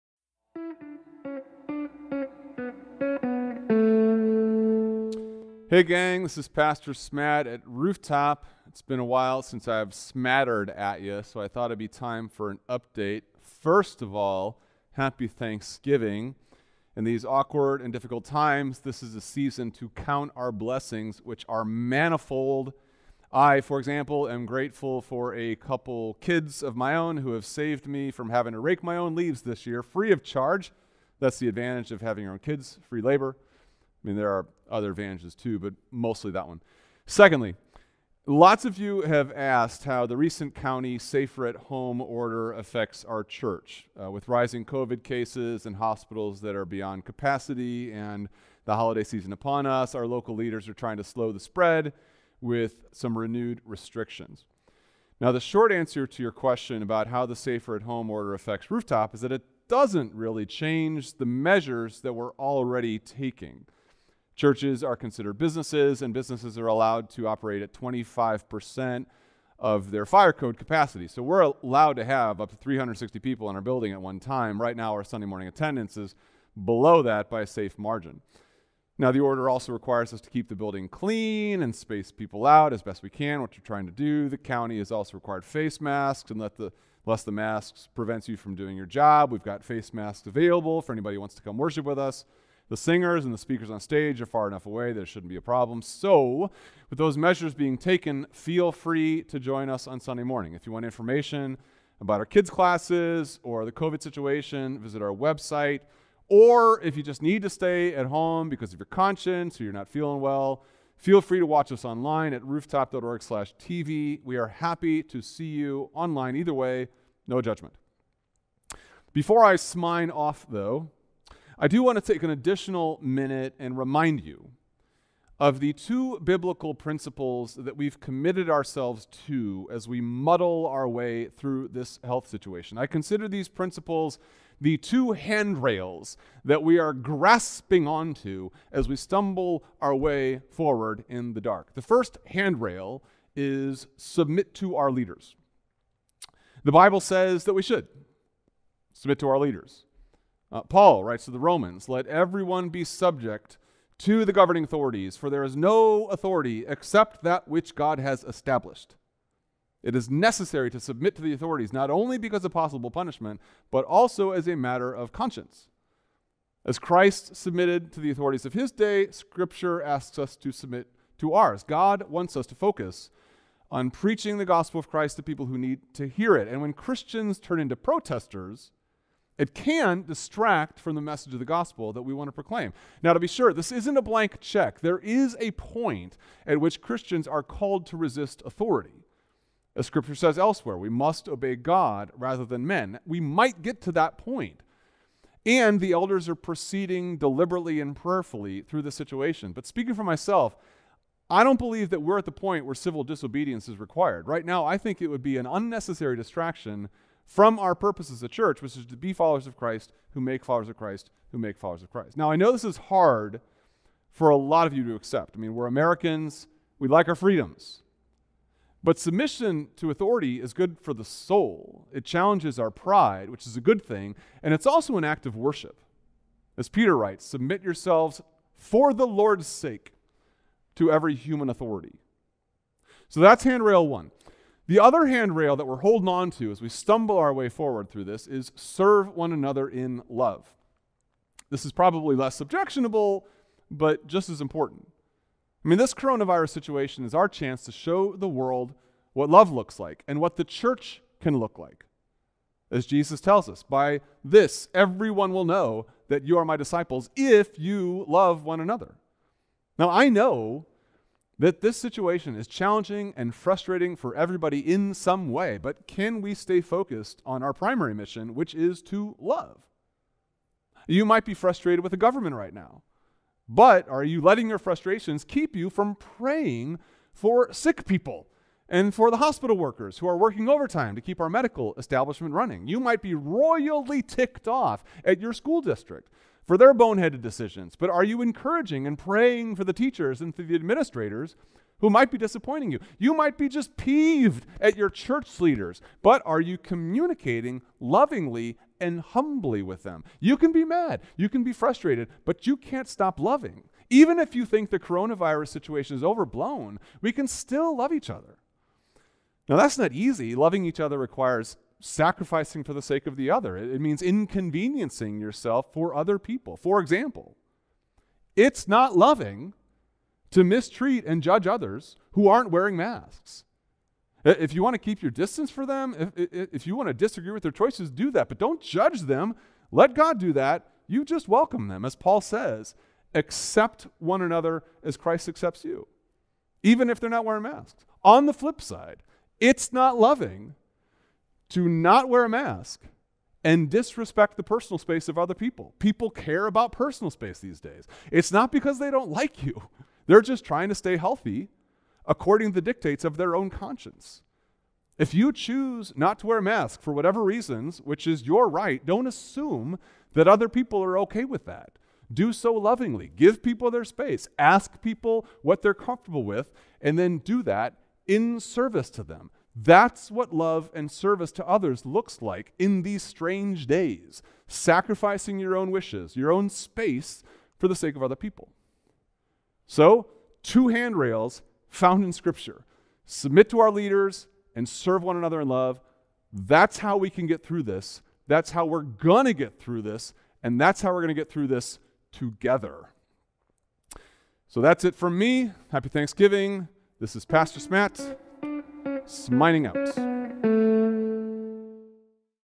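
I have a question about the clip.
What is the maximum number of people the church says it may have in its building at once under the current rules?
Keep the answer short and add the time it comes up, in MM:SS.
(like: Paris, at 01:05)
360, at 01:12.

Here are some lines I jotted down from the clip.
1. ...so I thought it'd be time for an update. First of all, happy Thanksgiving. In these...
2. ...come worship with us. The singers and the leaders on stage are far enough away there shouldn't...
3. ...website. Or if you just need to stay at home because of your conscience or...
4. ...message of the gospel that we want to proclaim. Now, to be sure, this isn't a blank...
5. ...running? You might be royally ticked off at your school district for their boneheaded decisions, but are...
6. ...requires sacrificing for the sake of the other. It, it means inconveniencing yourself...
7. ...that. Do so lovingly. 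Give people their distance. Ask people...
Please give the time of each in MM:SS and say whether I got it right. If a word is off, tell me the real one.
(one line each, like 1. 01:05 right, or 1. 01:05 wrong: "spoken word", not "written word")
1. 00:11 right
2. 01:31 wrong: "speakers", not "leaders"
3. 01:45 right
4. 03:01 right
5. 04:42 right
6. 05:10 right
7. 06:01 wrong: "space", not "distance".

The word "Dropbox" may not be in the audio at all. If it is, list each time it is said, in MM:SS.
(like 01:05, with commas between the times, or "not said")
not said.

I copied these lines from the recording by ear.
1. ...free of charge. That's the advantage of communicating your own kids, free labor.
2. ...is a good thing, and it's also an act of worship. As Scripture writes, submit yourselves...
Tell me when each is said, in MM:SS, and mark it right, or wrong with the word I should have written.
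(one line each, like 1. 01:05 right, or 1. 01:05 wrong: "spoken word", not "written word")
1. 00:29 wrong: "having", not "communicating"
2. 03:43 wrong: "Peter", not "Scripture".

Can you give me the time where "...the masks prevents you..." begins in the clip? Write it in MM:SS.
01:27.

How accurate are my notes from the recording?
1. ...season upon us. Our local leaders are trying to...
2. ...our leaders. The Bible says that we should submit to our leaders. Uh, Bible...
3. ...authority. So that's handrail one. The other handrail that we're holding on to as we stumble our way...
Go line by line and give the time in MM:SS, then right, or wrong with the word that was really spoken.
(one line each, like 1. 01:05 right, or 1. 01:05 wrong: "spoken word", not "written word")
1. 00:49 right
2. 02:24 wrong: "Paul", not "Bible"
3. 03:51 right.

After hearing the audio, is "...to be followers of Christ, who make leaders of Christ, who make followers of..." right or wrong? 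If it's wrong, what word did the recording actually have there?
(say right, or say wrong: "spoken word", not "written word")
wrong: "followers", not "leaders".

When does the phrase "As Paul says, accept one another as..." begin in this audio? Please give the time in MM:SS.
05:31.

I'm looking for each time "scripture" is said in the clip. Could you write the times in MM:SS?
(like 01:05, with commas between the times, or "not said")
02:49, 03:09, 06:22.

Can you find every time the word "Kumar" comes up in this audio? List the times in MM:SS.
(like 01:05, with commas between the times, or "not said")
not said.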